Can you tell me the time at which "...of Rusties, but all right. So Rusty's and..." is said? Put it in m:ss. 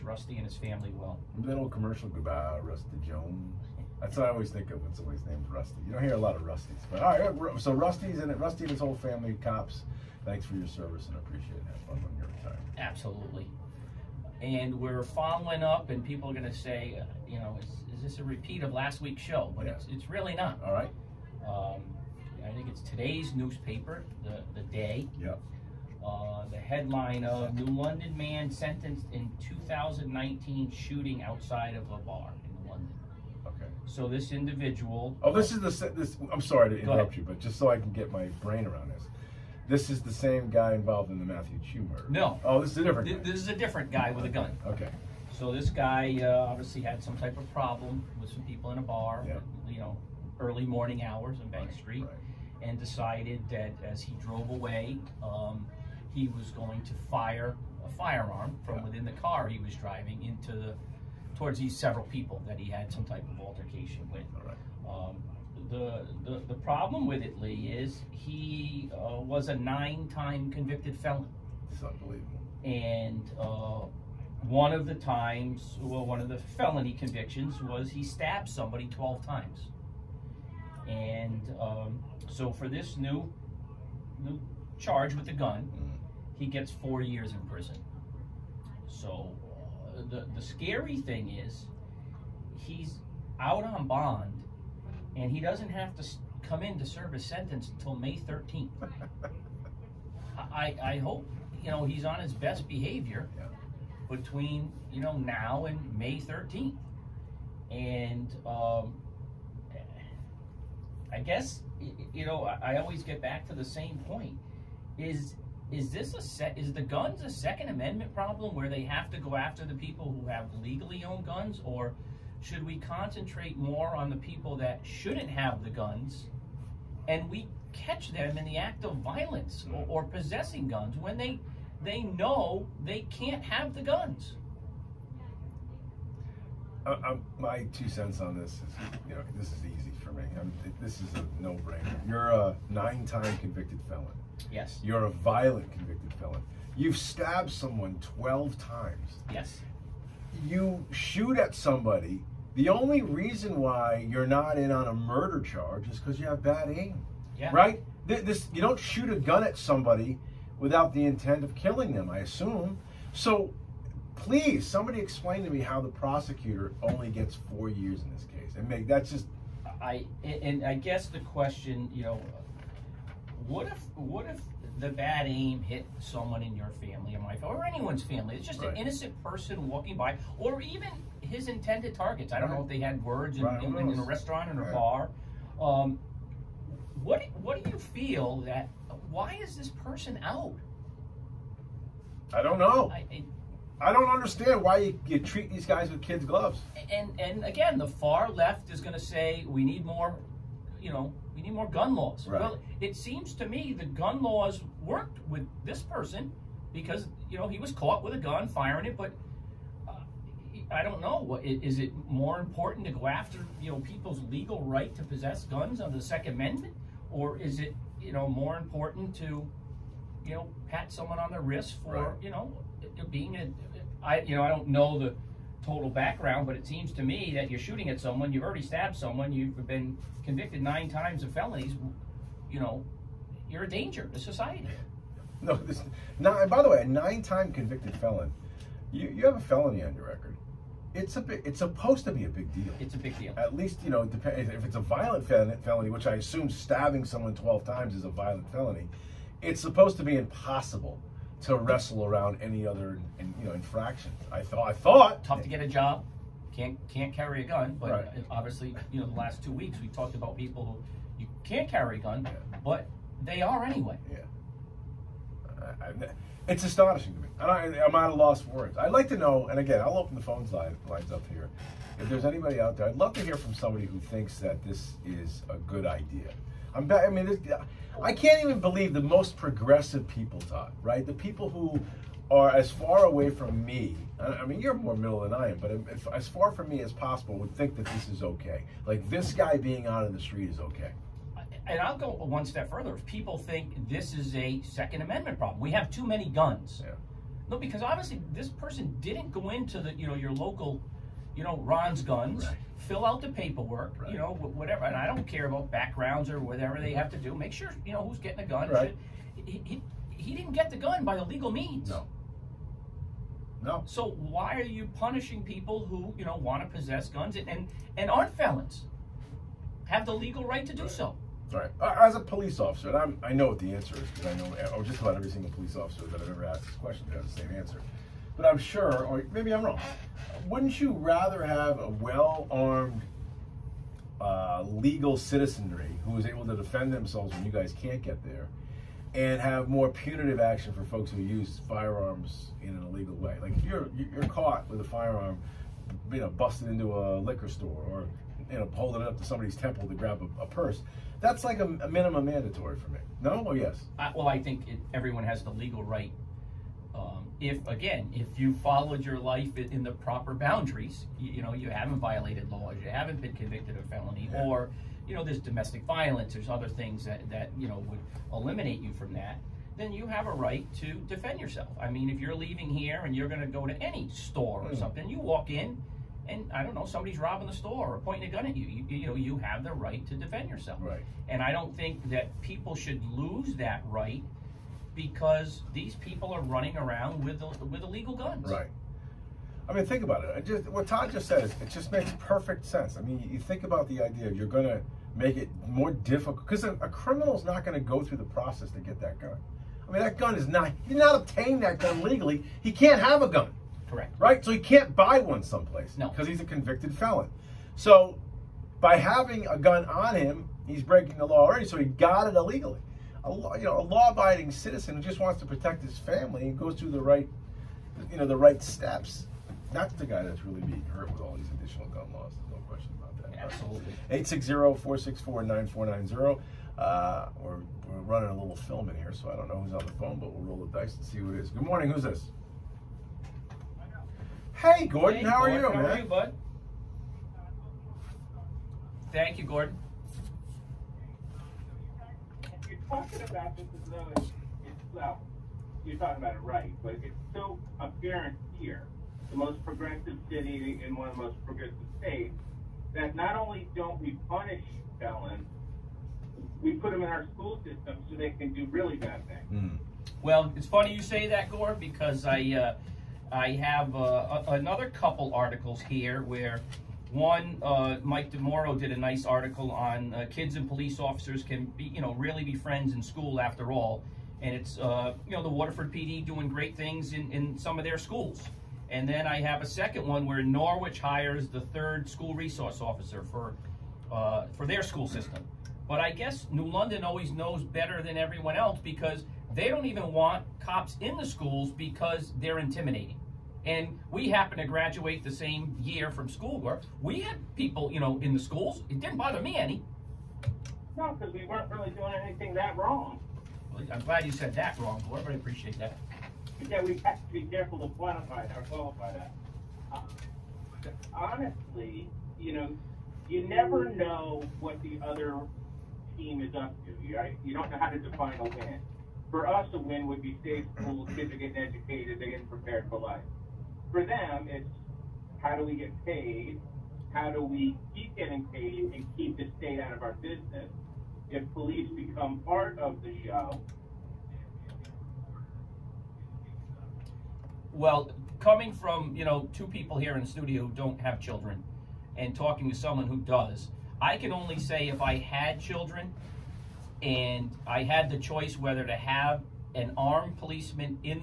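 0:06.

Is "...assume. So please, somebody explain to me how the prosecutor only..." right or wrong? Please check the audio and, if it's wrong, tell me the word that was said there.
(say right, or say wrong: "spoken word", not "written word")
right.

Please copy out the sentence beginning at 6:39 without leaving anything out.
I mean, that gun is not he did not obtain that gun legally.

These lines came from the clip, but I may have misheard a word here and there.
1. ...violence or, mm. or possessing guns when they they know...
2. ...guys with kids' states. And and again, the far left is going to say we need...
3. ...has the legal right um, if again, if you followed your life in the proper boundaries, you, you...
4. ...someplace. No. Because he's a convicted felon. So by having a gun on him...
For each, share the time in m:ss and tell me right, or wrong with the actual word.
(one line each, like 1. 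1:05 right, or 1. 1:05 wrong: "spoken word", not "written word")
1. 2:08 right
2. 3:15 wrong: "gloves", not "states"
3. 5:55 right
4. 6:45 right.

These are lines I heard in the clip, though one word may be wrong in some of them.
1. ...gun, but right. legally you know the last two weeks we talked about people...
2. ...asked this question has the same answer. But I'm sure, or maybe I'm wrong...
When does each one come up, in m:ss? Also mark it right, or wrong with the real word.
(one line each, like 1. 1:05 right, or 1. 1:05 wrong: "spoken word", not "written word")
1. 4:17 wrong: "obviously", not "legally"
2. 5:26 right.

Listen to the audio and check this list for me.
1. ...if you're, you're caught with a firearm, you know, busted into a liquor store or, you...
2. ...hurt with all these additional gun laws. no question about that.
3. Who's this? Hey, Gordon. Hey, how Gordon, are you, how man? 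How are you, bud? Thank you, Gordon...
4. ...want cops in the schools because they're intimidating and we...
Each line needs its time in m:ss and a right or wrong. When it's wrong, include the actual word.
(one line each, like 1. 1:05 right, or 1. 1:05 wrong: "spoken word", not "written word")
1. 5:43 right
2. 7:00 right
3. 7:11 right
4. 8:10 right.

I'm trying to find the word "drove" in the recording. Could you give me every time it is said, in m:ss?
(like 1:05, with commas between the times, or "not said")
0:54.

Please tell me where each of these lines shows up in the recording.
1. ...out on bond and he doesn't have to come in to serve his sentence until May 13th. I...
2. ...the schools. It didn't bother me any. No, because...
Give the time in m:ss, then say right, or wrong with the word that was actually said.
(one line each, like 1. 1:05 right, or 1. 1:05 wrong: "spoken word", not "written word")
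1. 1:33 right
2. 8:18 right.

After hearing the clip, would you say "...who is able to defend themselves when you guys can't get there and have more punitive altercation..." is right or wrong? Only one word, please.
wrong.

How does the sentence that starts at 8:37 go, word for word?
You don't know how to define a win.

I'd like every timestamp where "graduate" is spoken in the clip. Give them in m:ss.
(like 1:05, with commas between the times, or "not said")
8:14.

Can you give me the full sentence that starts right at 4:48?
Like this guy being out in the street is okay.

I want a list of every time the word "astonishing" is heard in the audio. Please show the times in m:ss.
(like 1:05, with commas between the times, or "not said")
4:26.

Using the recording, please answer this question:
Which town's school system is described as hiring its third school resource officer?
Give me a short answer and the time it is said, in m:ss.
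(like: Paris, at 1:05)
Norwich, at 8:00.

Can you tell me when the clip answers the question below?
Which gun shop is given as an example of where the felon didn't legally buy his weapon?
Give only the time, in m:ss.
5:01.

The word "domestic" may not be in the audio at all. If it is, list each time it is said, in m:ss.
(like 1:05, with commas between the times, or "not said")
6:05.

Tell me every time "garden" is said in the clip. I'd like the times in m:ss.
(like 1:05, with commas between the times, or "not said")
not said.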